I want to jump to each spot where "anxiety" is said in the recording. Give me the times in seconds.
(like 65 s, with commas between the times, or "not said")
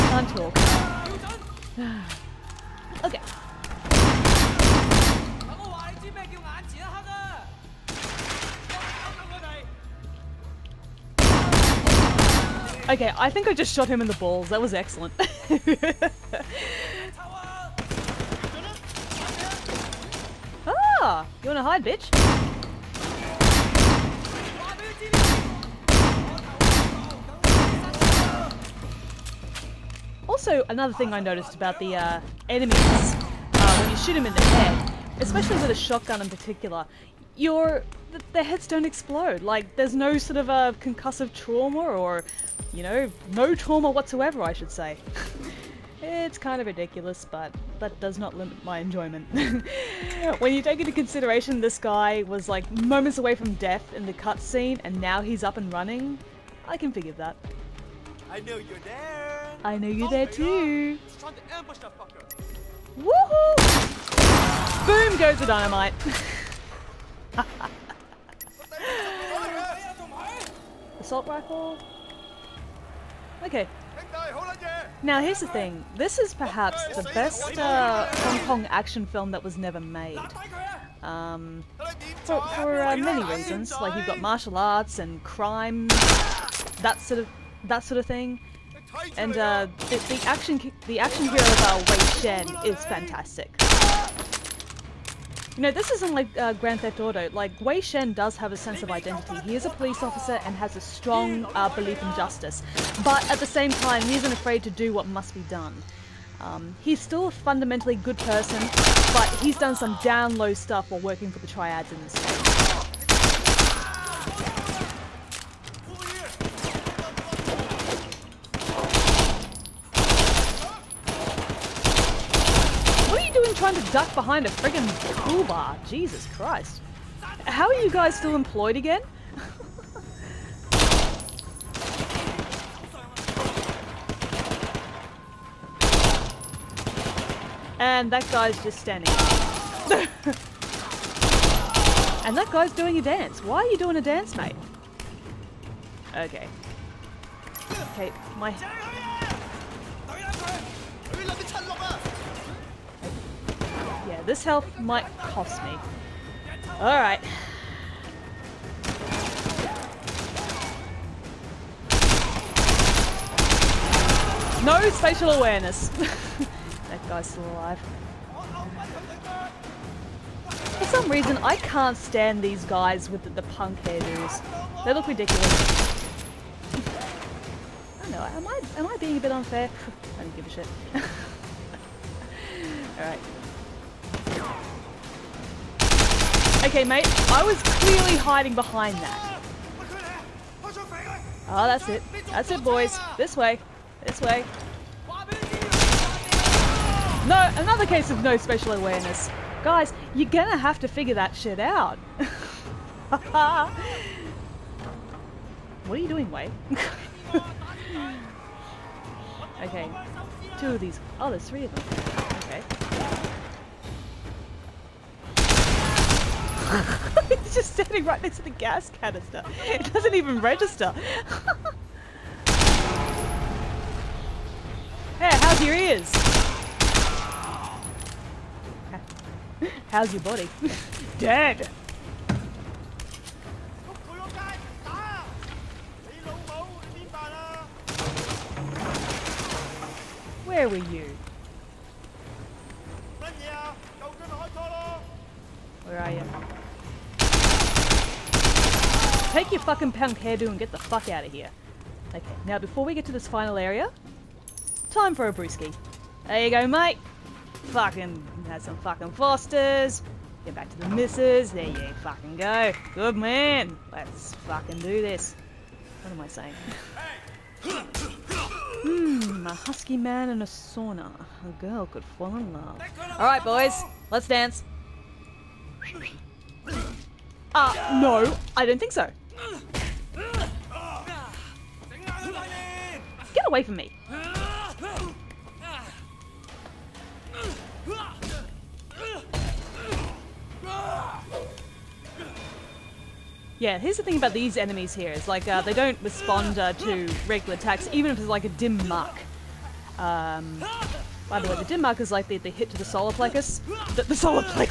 not said.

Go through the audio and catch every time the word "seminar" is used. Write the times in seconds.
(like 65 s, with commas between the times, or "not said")
not said.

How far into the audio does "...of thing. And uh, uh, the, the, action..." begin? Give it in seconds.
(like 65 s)
87 s.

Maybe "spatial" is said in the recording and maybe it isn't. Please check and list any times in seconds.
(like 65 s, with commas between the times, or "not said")
164 s, 198 s.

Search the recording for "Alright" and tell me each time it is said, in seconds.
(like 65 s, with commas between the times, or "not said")
156 s, 182 s, 273 s.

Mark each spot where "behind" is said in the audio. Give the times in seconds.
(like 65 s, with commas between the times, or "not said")
124 s, 188 s.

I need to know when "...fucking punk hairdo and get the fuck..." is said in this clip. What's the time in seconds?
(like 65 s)
249 s.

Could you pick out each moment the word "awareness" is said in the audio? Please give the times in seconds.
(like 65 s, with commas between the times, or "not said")
165 s, 198 s.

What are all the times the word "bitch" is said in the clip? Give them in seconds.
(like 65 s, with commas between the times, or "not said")
21 s.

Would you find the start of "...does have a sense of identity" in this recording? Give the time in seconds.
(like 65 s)
98 s.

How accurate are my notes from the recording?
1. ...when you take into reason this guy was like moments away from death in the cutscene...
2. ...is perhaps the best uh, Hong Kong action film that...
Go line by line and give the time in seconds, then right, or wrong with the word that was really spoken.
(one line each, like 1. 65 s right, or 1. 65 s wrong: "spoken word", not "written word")
1. 50 s wrong: "consideration", not "reason"
2. 76 s right.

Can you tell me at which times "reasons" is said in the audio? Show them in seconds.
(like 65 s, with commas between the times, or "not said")
83 s, 171 s.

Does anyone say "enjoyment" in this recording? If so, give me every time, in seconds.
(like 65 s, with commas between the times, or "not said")
48 s.